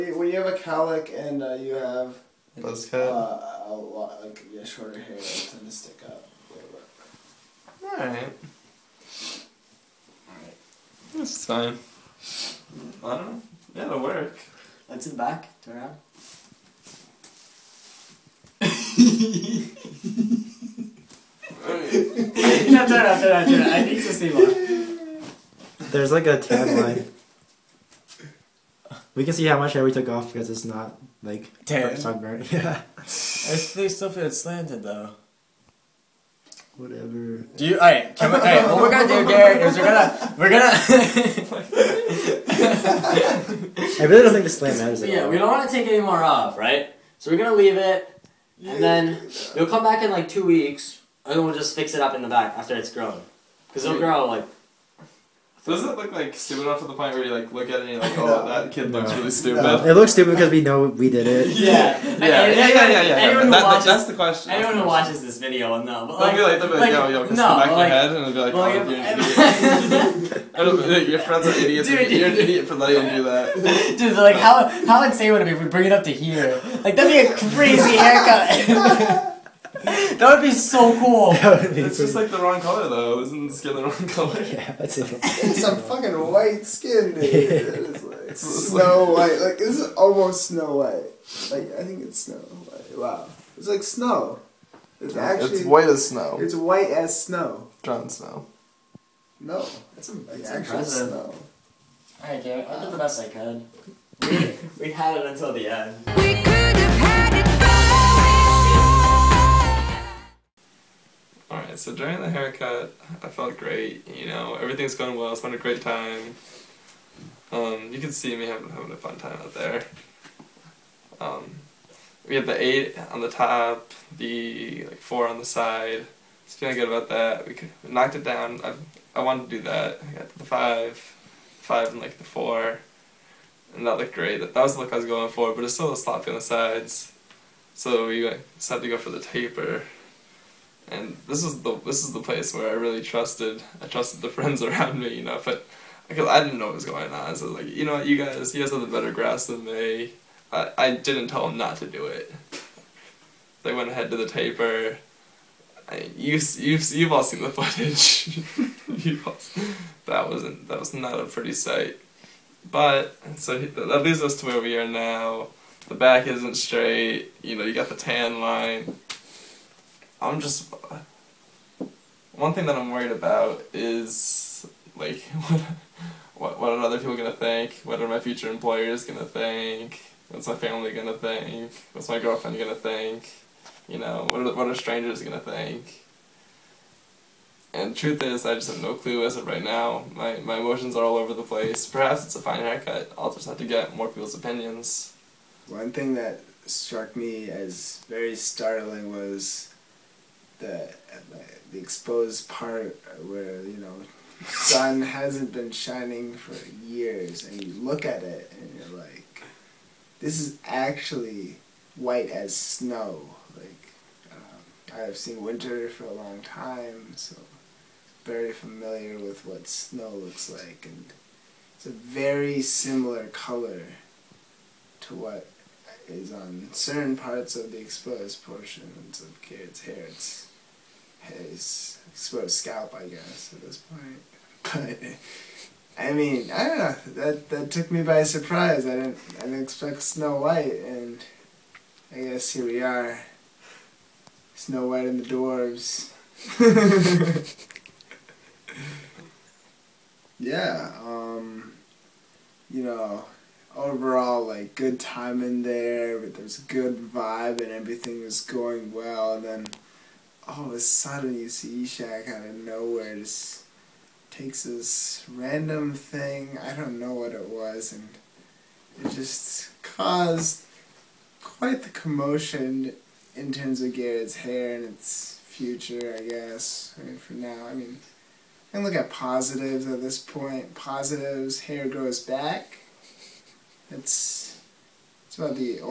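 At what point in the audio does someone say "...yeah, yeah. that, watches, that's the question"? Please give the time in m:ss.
1:02.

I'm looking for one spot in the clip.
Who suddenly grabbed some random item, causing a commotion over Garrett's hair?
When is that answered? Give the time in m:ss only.
4:21.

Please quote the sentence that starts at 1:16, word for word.
Like that'd be a crazy haircut.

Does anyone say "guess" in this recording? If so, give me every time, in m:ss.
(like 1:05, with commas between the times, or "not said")
3:53, 4:02, 4:36.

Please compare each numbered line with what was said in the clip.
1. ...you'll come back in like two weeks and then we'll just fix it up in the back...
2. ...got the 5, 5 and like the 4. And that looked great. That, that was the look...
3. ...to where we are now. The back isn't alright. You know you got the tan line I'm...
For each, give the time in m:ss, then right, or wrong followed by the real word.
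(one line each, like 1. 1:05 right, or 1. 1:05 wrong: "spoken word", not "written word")
1. 0:49 right
2. 2:10 right
3. 2:44 wrong: "straight", not "alright".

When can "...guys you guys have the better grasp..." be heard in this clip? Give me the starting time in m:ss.
2:28.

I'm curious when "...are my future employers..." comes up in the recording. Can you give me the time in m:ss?
2:58.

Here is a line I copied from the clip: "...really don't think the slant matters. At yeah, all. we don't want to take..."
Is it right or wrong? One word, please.
right.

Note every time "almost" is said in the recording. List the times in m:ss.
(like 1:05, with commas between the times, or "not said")
1:29.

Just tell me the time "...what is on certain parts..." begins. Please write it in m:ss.
3:45.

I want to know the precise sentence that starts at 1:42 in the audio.
Alright, Garrett, I did the best I could.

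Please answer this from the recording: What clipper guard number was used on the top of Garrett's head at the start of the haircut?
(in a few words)
8.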